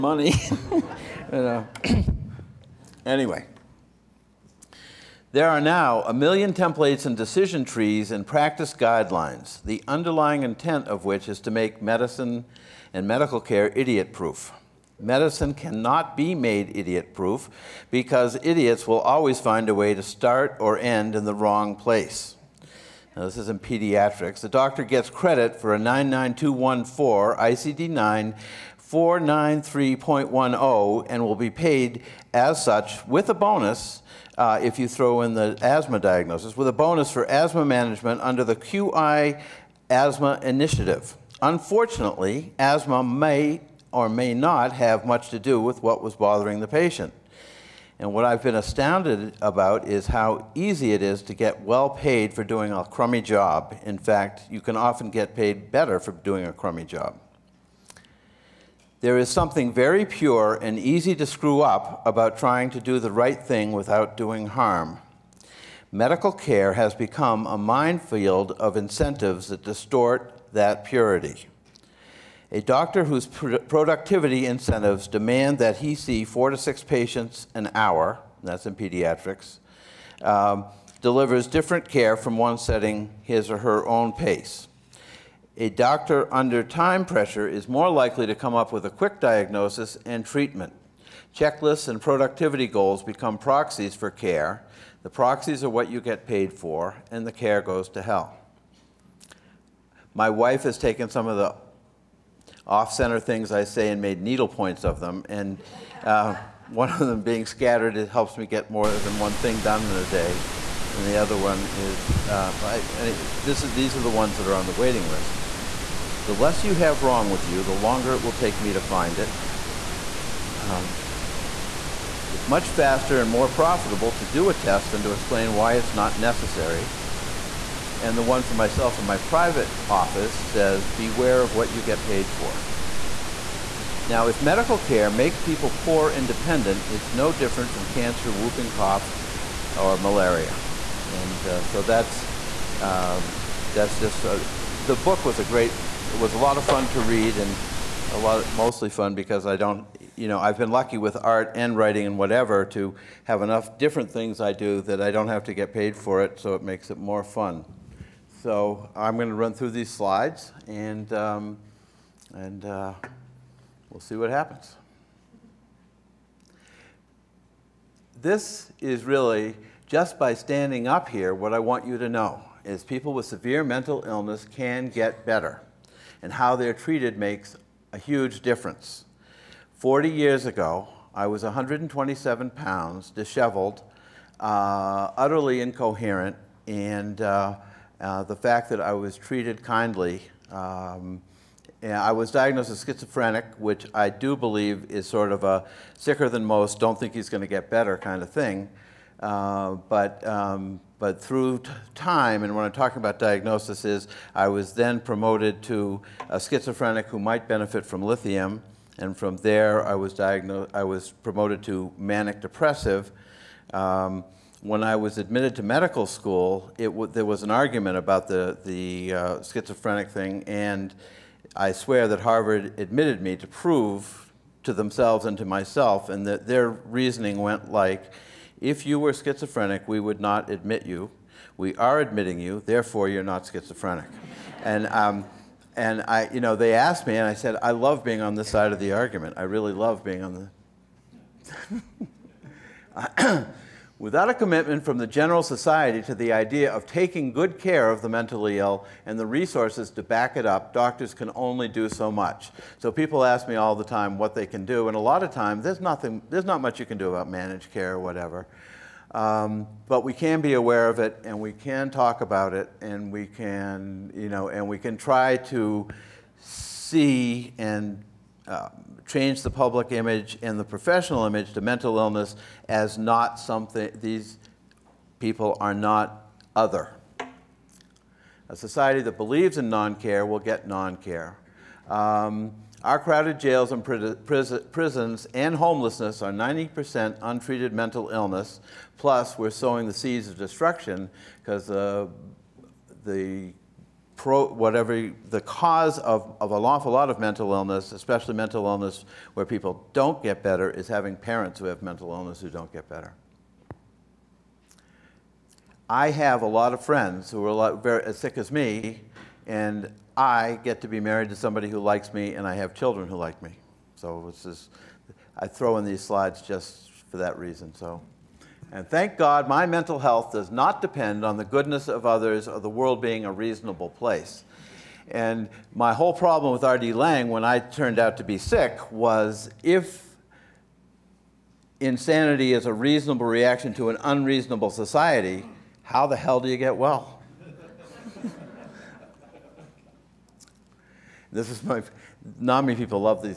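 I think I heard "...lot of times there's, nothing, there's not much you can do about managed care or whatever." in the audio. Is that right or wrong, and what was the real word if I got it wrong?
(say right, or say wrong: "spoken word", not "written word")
right.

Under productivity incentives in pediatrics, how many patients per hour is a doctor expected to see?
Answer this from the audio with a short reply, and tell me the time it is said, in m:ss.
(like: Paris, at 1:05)
4 to 6, at 1:16.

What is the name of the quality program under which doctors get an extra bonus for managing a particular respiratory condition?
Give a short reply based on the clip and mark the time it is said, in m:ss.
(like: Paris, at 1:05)
QI Asthma Initiative, at 0:38.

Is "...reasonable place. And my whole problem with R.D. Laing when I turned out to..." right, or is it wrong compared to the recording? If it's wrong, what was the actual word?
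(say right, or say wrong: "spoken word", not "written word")
right.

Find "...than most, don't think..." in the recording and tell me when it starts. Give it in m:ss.
3:16.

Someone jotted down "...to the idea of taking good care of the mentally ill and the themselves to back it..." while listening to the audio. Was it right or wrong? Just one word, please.
wrong.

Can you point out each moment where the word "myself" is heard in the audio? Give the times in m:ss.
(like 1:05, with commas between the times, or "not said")
2:08, 3:45.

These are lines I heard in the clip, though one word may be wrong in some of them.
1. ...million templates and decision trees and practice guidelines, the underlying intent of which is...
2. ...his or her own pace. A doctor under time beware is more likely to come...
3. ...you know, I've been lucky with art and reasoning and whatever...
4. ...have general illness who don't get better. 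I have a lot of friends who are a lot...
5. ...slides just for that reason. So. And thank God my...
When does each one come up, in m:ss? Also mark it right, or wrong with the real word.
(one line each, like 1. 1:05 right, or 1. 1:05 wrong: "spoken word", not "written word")
1. 0:06 right
2. 1:23 wrong: "pressure", not "beware"
3. 2:30 wrong: "writing", not "reasoning"
4. 5:01 wrong: "mental", not "general"
5. 5:16 right.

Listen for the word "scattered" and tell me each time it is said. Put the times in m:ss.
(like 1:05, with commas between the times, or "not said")
1:47.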